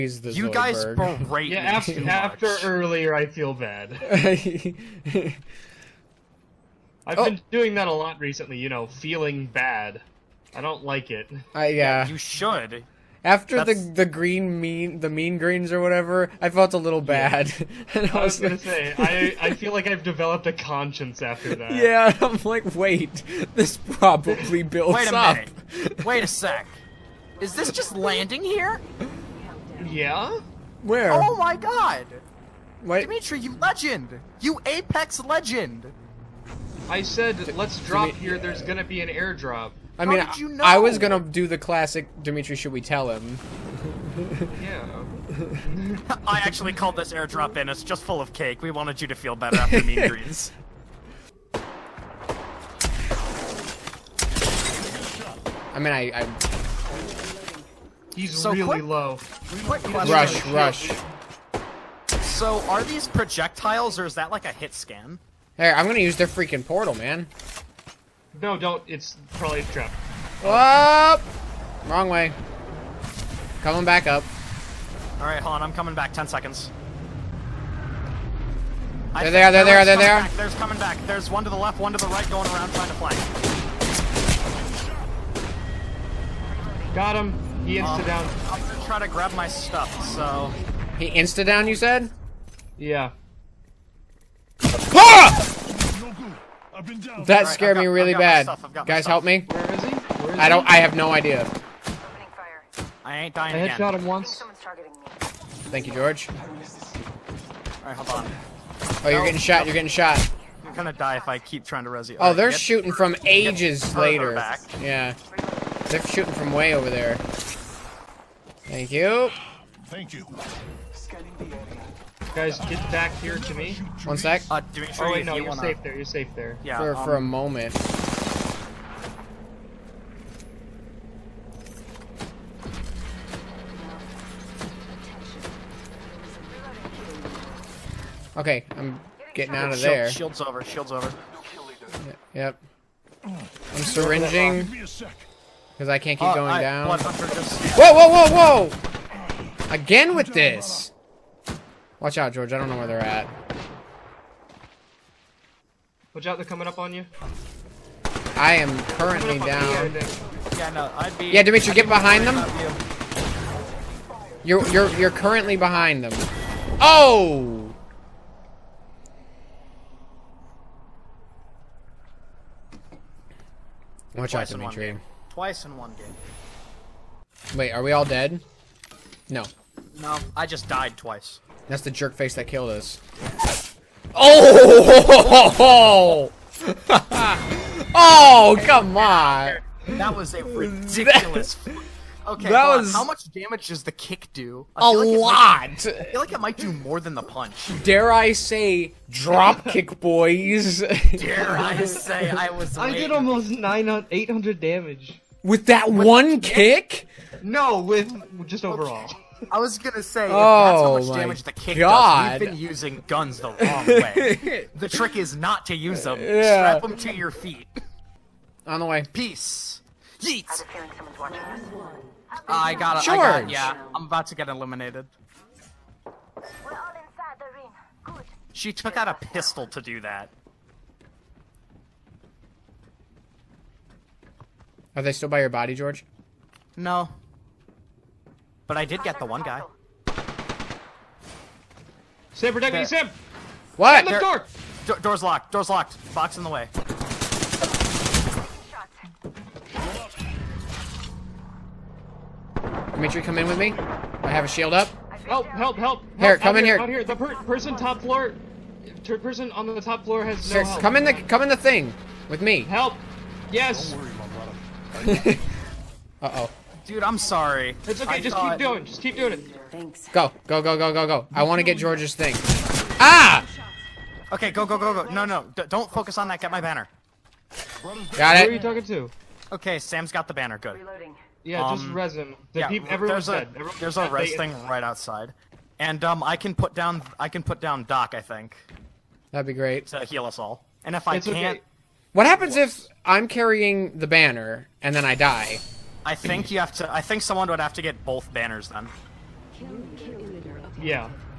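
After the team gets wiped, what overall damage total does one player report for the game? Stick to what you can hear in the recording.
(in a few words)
800.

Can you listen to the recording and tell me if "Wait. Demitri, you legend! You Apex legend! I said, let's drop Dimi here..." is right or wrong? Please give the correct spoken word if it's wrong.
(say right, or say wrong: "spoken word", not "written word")
right.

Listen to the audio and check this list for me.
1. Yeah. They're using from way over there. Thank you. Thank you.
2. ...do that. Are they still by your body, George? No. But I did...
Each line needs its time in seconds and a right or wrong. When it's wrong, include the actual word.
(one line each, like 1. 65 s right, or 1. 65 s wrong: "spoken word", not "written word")
1. 114 s wrong: "shooting", not "using"
2. 229 s right.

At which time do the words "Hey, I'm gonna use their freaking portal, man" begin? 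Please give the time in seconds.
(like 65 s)
65 s.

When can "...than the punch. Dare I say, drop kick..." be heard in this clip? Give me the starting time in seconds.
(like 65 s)
196 s.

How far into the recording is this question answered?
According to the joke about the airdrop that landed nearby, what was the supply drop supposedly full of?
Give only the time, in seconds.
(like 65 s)
48 s.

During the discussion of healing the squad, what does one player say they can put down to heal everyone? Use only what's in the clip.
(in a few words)
Doc.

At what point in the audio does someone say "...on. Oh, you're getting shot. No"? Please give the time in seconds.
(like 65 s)
108 s.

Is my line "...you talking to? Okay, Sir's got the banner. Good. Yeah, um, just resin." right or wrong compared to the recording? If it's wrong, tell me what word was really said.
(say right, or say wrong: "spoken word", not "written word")
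wrong: "Sam", not "Sir".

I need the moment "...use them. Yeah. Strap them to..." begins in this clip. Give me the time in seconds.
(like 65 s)
215 s.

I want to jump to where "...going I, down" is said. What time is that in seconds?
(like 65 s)
146 s.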